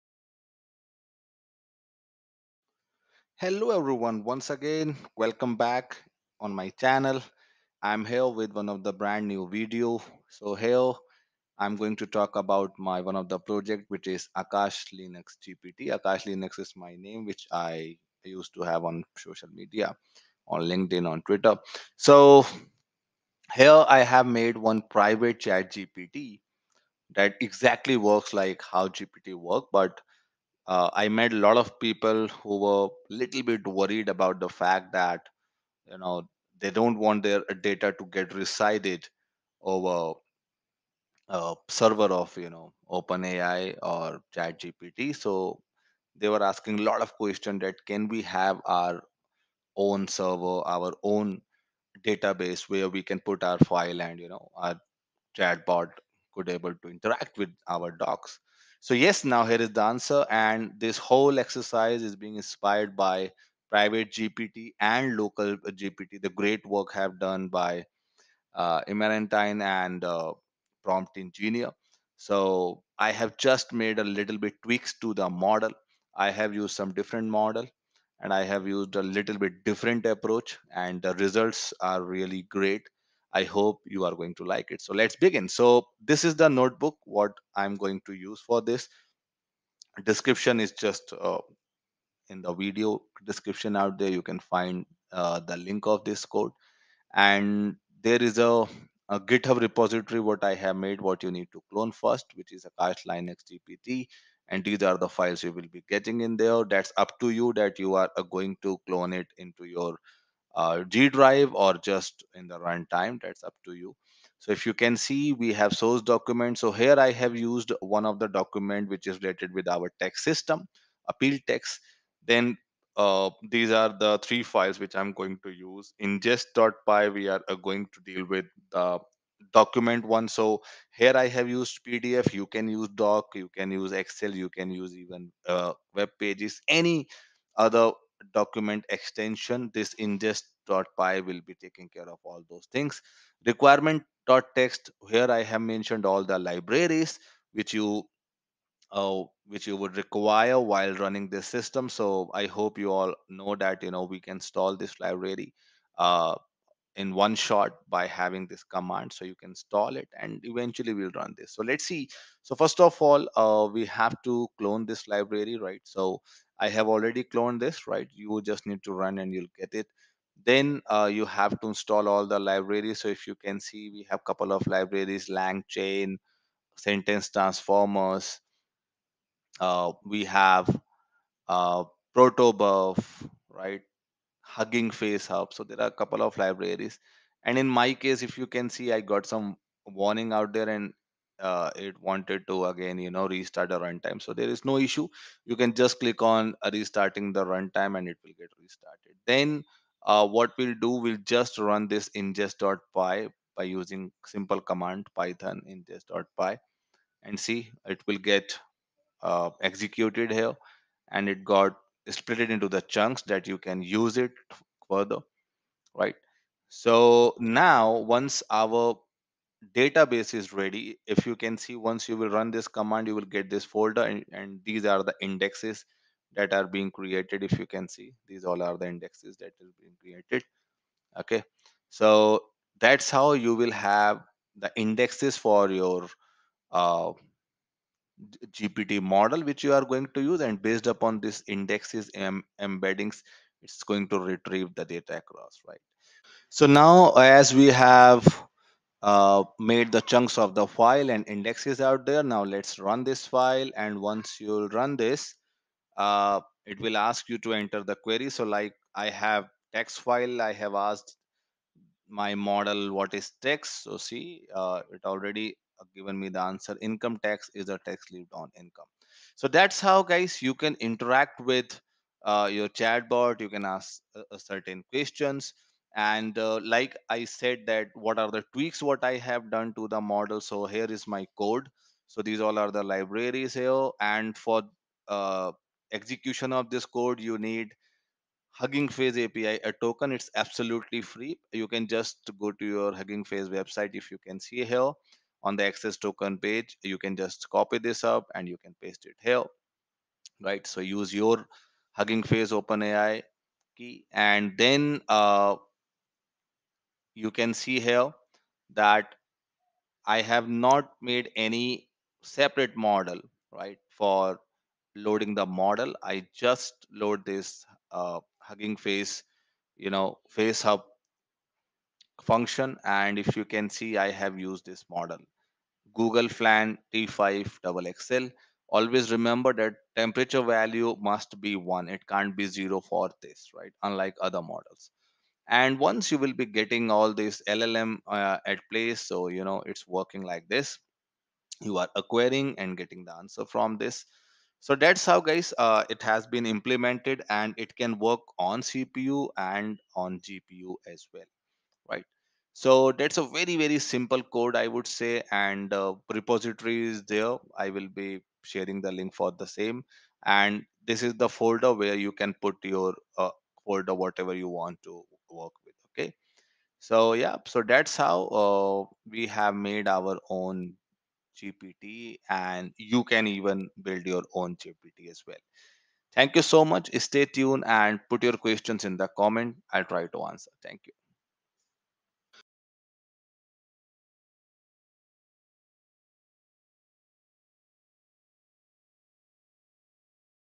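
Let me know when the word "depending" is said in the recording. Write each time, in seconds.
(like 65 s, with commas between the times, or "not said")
not said.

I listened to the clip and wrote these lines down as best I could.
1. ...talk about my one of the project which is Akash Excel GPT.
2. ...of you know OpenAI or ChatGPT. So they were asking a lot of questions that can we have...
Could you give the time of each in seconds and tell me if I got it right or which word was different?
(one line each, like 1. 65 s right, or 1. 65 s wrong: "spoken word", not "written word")
1. 12 s wrong: "Linux", not "Excel"
2. 42 s right.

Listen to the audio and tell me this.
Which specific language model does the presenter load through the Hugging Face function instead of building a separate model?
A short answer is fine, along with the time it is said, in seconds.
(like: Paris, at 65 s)
Google Flan T5 XXL, at 325 s.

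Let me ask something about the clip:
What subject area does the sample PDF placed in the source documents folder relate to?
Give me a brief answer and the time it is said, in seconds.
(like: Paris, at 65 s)
Tax system, at 119 s.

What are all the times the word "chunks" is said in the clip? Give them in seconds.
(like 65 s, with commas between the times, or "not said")
212 s, 250 s.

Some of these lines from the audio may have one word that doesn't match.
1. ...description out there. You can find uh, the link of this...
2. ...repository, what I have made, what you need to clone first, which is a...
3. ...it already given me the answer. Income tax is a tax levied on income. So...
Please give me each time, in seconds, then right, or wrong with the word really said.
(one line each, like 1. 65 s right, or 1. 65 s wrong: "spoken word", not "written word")
1. 93 s right
2. 99 s right
3. 264 s right.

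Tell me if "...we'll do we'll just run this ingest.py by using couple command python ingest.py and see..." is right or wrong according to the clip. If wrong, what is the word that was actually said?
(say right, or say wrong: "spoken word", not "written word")
wrong: "simple", not "couple".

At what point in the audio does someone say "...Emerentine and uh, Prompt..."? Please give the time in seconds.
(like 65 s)
68 s.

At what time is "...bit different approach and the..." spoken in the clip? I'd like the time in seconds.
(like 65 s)
79 s.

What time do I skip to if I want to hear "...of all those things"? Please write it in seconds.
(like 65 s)
142 s.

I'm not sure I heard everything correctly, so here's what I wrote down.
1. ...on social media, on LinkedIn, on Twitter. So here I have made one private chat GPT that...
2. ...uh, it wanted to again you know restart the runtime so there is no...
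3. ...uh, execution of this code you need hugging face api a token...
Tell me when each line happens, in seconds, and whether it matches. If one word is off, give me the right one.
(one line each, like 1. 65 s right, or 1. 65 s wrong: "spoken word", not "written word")
1. 18 s right
2. 191 s right
3. 285 s right.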